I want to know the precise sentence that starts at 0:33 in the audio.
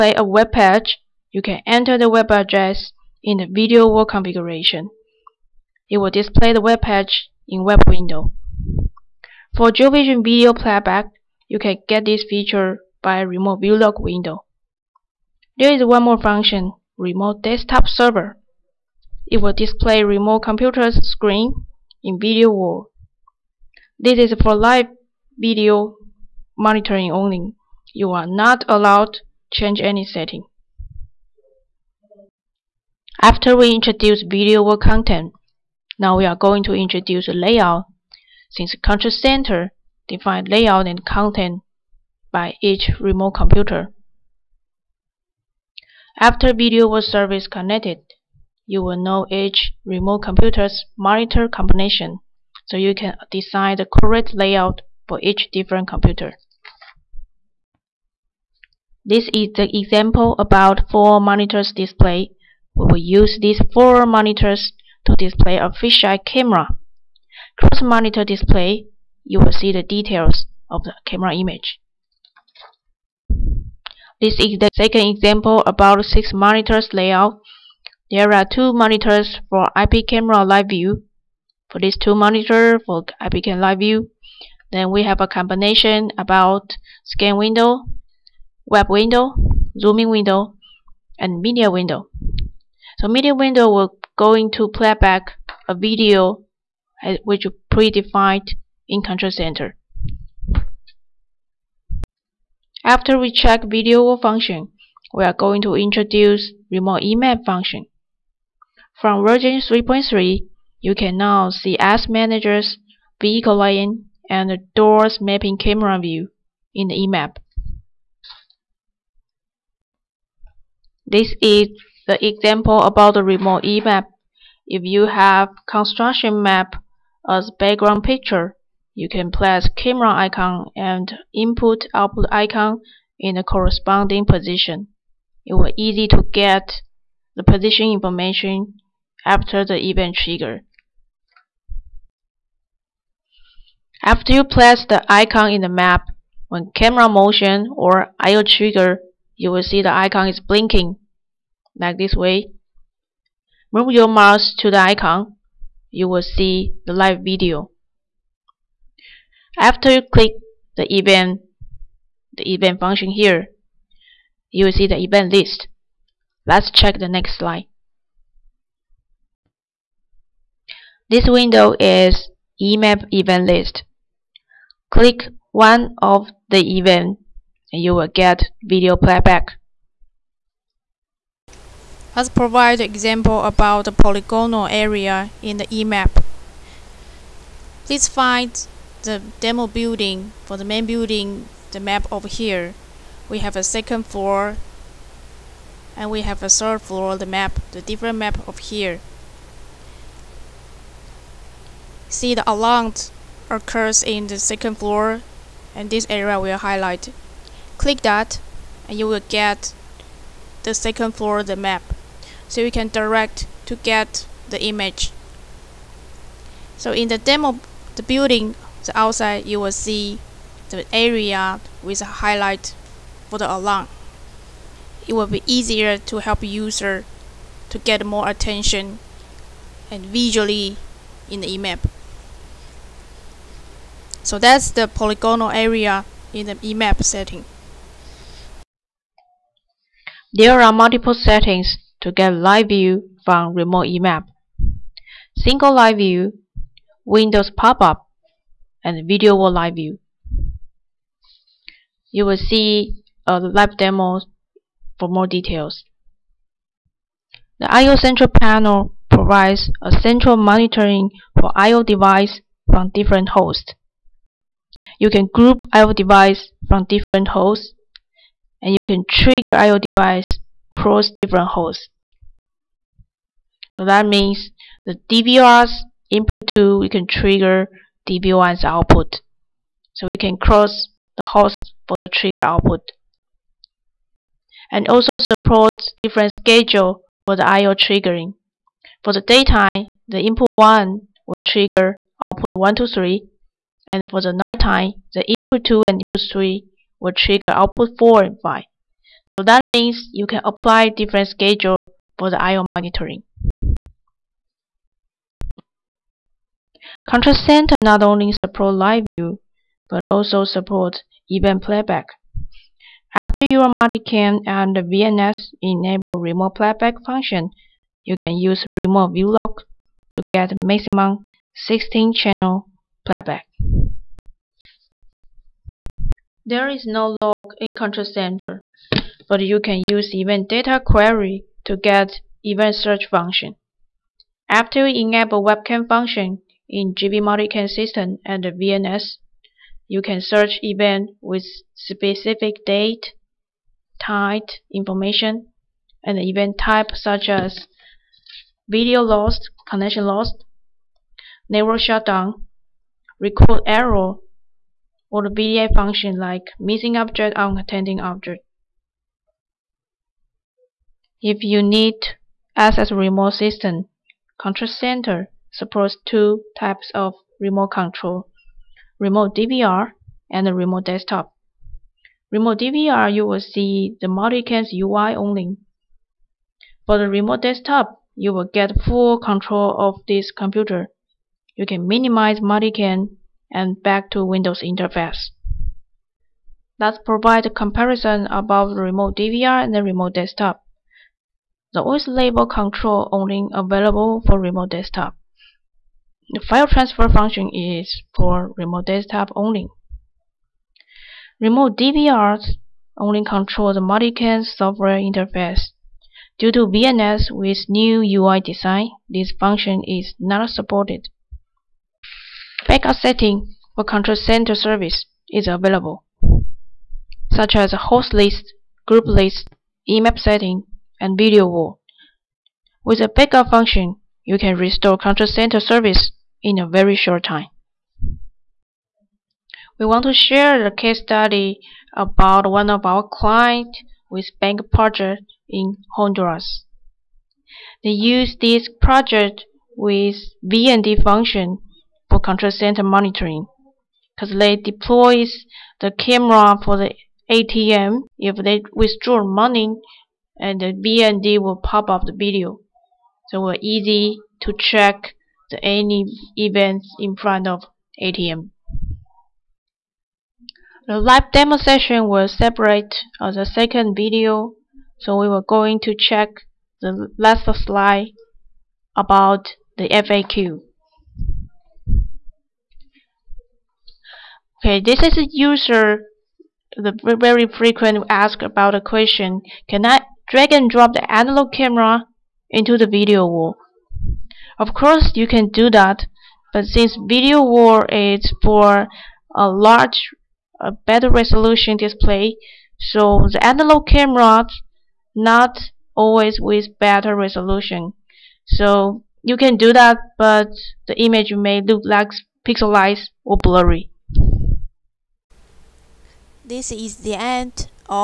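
After we introduce video wall content, now we are going to introduce layout.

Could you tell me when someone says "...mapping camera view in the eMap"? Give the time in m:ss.
1:55.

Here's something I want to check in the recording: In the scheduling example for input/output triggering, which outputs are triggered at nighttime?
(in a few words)
Outputs 4 and 5.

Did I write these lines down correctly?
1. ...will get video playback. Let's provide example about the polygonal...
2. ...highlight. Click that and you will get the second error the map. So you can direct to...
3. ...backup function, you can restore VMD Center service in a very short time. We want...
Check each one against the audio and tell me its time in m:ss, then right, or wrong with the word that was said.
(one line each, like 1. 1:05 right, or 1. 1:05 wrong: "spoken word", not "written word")
1. 2:57 right
2. 3:26 wrong: "floor", not "error"
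3. 7:03 wrong: "Control", not "VMD".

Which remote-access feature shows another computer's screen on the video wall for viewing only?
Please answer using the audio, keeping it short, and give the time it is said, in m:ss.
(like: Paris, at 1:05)
Remote desktop server, at 0:16.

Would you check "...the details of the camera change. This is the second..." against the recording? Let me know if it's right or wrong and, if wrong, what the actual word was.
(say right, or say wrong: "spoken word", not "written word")
wrong: "image", not "change".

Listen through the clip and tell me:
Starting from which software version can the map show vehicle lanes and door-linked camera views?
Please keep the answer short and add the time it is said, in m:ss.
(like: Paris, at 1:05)
3.3, at 1:49.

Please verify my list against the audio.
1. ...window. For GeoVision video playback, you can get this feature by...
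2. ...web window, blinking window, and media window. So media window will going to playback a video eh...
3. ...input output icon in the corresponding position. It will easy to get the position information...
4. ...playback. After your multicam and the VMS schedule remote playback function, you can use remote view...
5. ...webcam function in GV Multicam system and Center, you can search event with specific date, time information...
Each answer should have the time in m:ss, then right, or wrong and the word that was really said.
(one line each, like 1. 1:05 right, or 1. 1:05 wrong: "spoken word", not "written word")
1. 0:07 right
2. 1:28 wrong: "zooming", not "blinking"
3. 2:11 right
4. 5:11 wrong: "enable", not "schedule"
5. 5:35 wrong: "VMS", not "Center".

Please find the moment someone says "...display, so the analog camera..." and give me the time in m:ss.
8:11.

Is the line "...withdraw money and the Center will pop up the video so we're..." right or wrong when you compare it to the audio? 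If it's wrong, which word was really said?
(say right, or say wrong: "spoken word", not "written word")
wrong: "VMD", not "Center".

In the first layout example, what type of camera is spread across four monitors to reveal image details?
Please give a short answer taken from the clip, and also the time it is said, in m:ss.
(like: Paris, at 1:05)
Fisheye camera, at 1:05.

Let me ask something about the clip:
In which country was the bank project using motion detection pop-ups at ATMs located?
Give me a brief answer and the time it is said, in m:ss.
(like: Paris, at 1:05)
Honduras, at 7:15.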